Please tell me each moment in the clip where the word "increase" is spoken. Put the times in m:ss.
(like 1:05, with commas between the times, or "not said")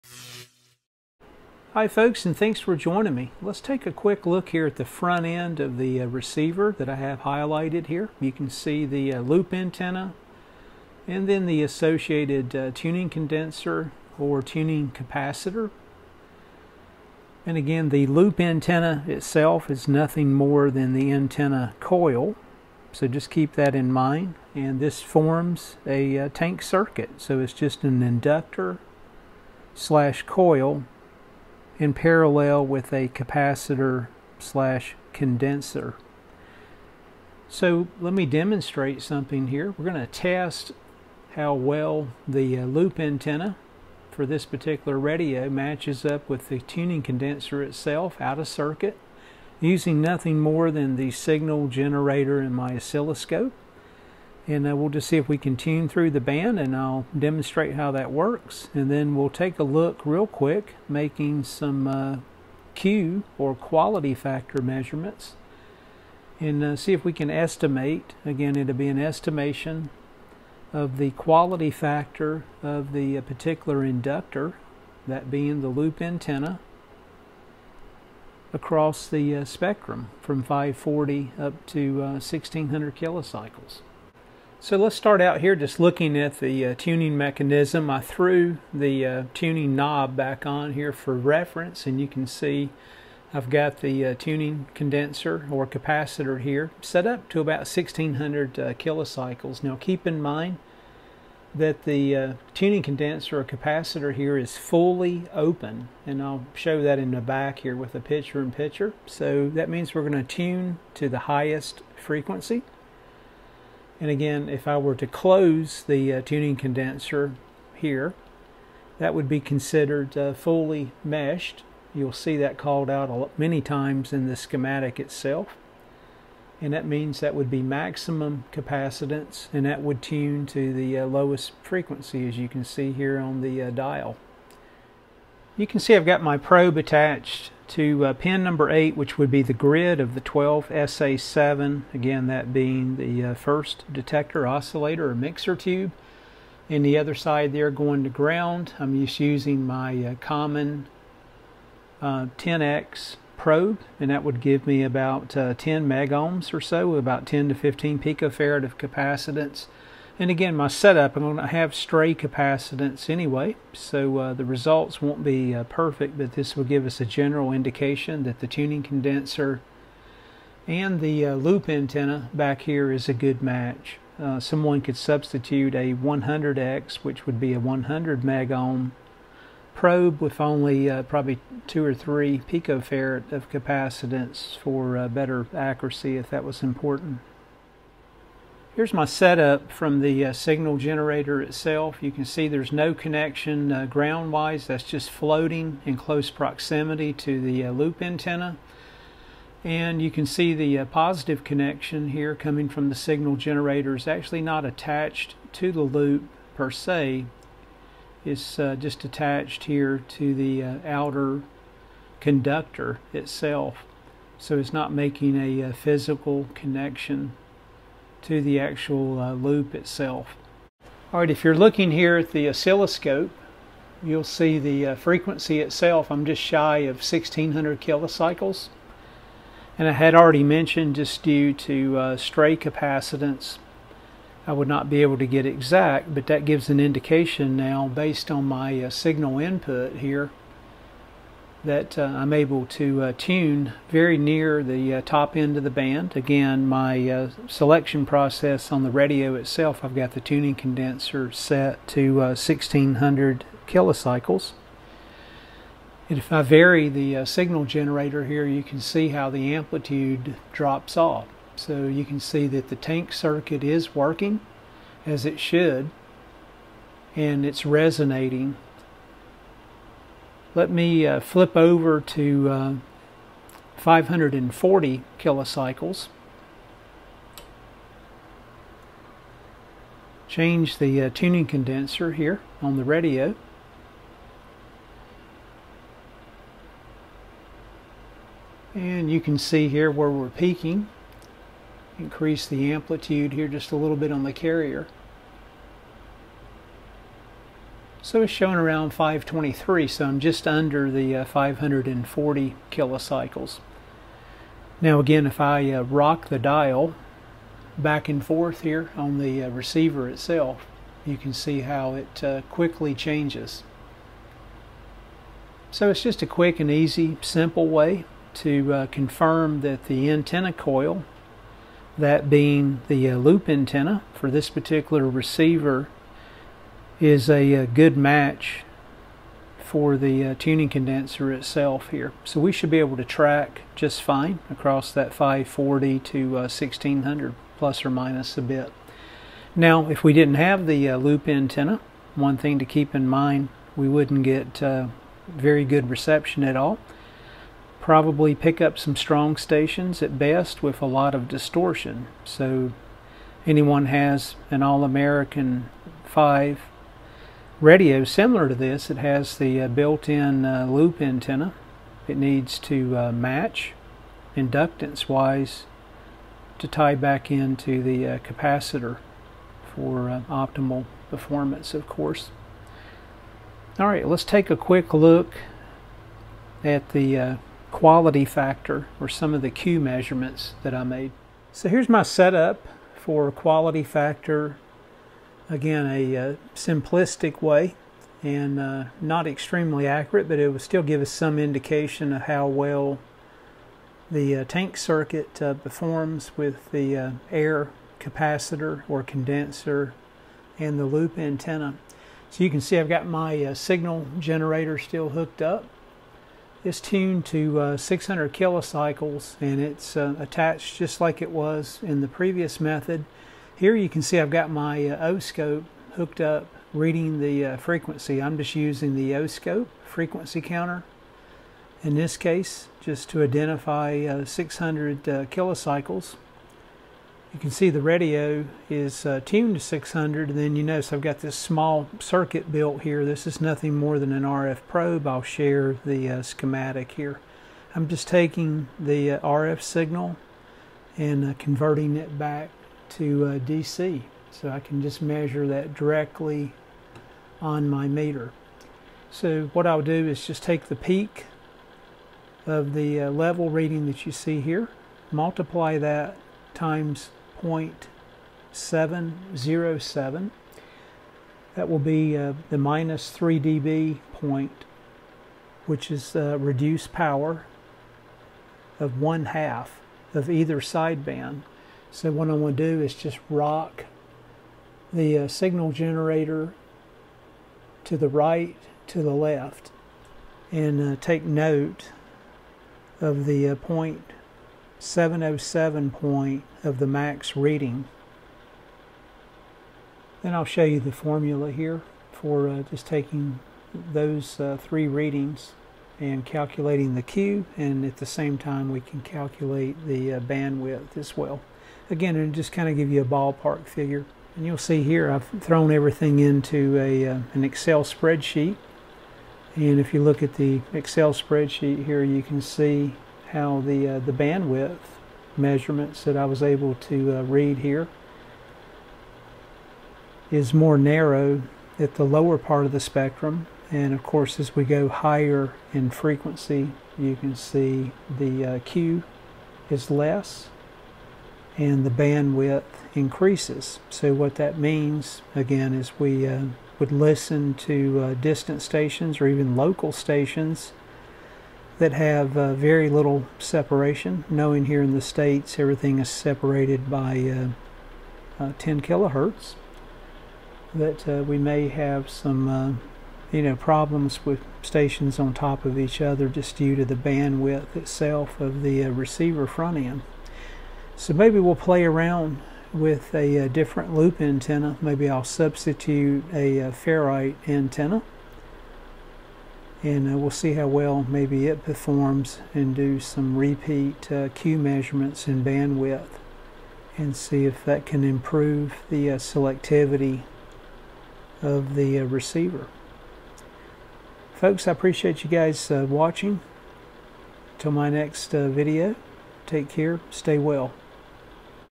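4:51, 8:52.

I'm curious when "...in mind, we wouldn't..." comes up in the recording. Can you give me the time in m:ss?
5:42.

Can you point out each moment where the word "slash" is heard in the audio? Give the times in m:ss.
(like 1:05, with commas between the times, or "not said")
0:29, 0:34.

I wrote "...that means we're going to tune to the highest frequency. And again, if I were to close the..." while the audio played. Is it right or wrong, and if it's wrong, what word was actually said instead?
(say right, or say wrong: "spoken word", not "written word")
right.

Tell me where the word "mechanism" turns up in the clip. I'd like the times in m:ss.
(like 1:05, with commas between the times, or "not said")
1:27.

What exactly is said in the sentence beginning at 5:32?
So we should be able to track just fine across that 540 to uh, 1600 plus or minus a bit.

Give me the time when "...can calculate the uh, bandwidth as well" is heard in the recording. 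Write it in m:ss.
8:18.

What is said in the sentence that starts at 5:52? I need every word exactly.
So anyone has an All-American 5 radio similar to this.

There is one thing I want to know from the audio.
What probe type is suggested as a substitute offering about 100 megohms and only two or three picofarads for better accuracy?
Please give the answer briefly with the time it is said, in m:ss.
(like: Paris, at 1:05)
100X, at 2:55.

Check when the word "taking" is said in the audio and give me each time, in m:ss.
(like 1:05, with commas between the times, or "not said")
7:18, 8:12.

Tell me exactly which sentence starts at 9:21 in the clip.
So maybe we'll play around with a, a uh, different loop antenna.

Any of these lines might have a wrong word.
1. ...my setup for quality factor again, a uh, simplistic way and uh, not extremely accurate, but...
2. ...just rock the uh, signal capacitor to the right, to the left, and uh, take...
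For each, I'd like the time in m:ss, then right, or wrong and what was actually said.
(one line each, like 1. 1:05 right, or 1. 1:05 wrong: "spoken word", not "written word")
1. 6:21 right
2. 7:52 wrong: "generator", not "capacitor".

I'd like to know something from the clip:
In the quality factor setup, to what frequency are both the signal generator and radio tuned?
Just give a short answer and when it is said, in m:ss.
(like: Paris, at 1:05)
600 kilocycles, at 6:47.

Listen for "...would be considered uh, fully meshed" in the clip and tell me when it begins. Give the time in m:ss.
1:59.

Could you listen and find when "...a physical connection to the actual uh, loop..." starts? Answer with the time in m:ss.
3:35.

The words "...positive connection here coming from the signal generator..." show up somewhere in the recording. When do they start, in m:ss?
3:20.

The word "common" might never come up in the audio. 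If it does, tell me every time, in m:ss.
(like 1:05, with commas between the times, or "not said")
2:30.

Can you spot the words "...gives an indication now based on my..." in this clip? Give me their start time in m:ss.
3:56.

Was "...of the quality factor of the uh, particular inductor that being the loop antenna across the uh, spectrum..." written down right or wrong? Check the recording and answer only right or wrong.
right.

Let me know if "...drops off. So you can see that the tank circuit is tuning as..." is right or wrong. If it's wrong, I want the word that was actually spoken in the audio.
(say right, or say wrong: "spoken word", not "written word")
wrong: "working", not "tuning".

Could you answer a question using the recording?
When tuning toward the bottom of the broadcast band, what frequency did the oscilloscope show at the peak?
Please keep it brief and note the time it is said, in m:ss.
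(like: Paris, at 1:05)
523, at 4:58.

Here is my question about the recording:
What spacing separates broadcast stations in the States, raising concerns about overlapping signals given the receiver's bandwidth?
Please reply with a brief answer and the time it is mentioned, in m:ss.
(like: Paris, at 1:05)
10 kilohertz, at 9:08.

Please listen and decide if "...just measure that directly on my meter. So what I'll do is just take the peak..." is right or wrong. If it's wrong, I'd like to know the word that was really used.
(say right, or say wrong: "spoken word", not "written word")
right.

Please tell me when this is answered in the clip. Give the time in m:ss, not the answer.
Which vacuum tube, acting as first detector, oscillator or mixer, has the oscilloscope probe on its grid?
2:20.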